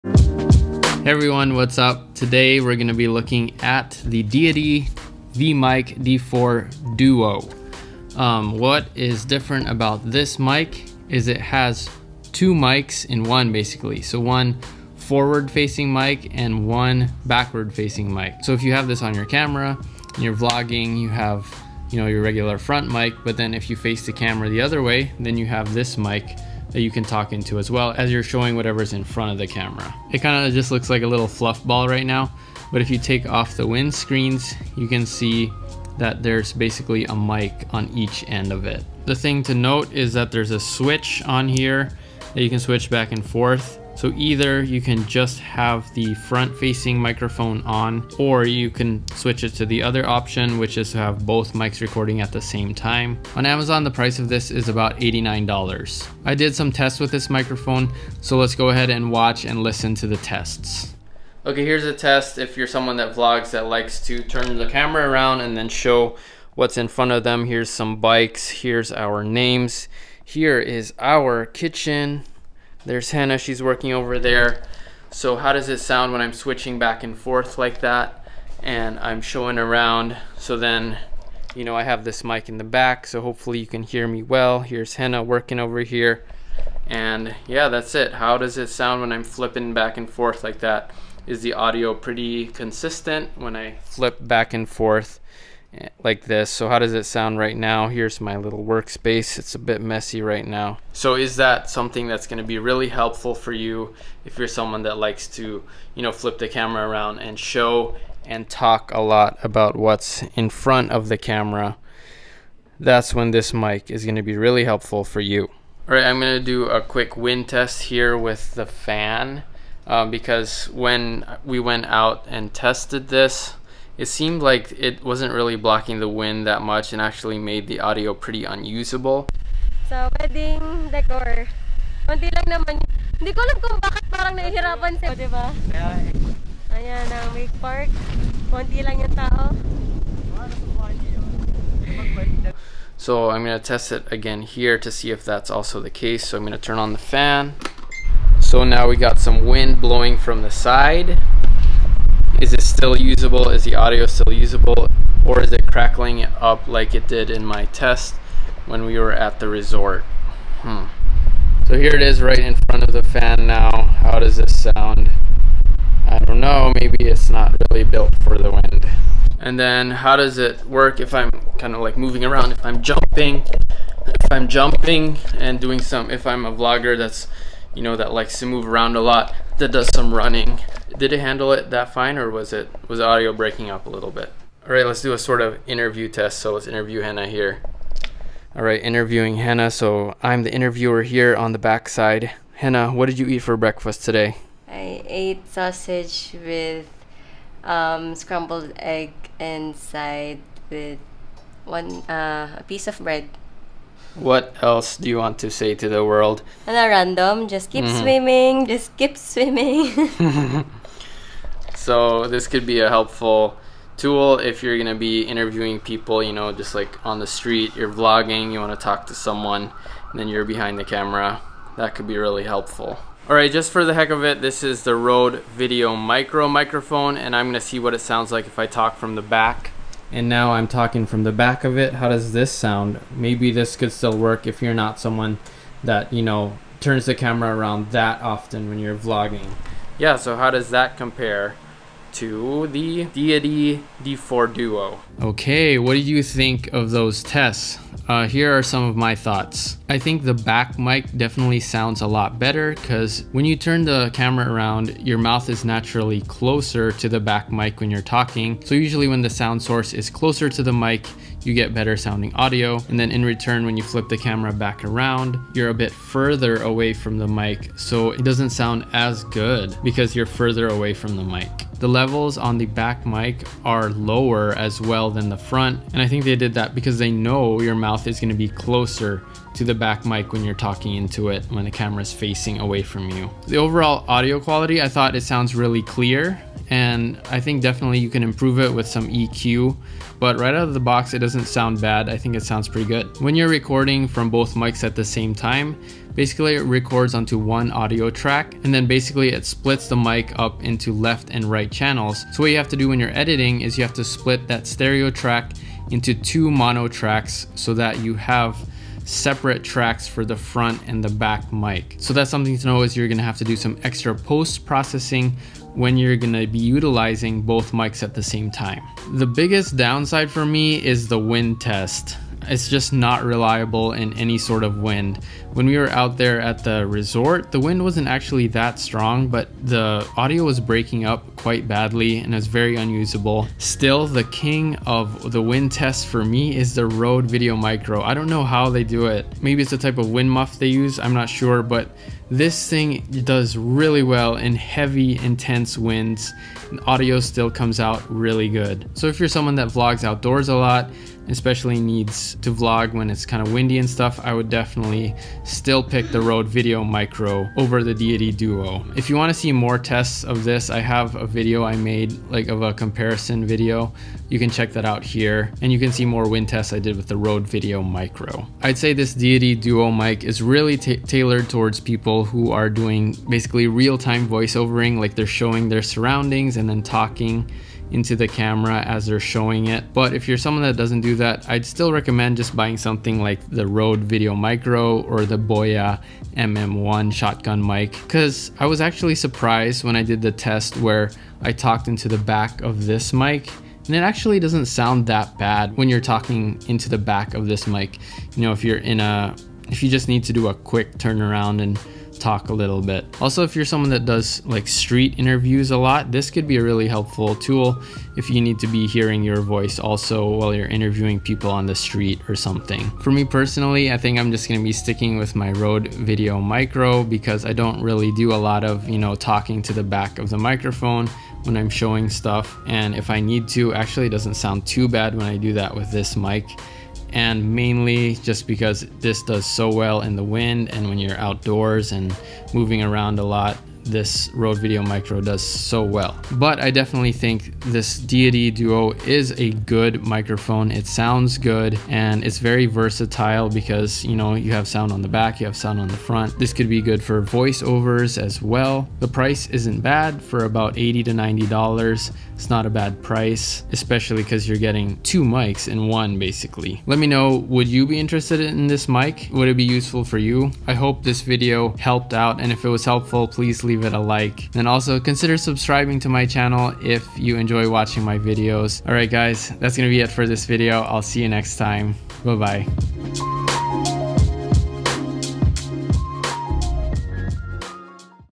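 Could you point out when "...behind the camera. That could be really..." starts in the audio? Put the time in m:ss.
3:40.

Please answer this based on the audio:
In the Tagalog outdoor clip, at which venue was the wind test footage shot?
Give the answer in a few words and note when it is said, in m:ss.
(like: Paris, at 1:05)
Wake Park, at 2:17.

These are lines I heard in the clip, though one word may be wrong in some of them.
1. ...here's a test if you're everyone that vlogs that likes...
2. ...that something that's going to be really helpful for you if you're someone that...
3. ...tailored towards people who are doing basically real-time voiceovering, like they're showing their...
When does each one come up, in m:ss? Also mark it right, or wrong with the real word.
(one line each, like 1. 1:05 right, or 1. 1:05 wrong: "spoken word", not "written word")
1. 1:01 wrong: "someone", not "everyone"
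2. 1:41 right
3. 6:10 right.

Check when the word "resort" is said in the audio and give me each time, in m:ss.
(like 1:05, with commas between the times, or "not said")
2:39, 5:26.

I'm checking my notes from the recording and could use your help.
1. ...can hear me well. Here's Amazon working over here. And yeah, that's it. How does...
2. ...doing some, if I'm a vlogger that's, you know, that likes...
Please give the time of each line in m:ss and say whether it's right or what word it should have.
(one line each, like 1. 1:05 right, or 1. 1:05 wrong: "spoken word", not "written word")
1. 1:23 wrong: "Hannah", not "Amazon"
2. 2:55 right.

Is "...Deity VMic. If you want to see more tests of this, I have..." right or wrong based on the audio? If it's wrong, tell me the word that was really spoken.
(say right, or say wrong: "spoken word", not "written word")
wrong: "Duo", not "VMic".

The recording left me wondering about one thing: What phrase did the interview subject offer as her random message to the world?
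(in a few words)
Just keep swimming.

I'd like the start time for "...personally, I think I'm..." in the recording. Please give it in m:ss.
6:53.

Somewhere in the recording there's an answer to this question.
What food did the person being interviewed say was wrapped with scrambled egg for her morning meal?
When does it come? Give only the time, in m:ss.
3:15.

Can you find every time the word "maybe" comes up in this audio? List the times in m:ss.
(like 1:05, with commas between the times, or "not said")
2:46, 3:53, 5:39.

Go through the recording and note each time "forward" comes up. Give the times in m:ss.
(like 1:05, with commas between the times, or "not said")
0:14.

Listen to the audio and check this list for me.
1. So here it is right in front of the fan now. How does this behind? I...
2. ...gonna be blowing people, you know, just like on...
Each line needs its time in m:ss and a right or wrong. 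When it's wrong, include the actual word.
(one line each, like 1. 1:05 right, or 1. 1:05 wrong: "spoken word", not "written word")
1. 2:41 wrong: "sound", not "behind"
2. 3:34 wrong: "interviewing", not "blowing".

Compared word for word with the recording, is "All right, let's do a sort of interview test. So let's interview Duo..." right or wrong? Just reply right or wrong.
wrong.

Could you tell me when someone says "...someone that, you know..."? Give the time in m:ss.
3:54.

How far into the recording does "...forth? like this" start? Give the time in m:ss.
1:34.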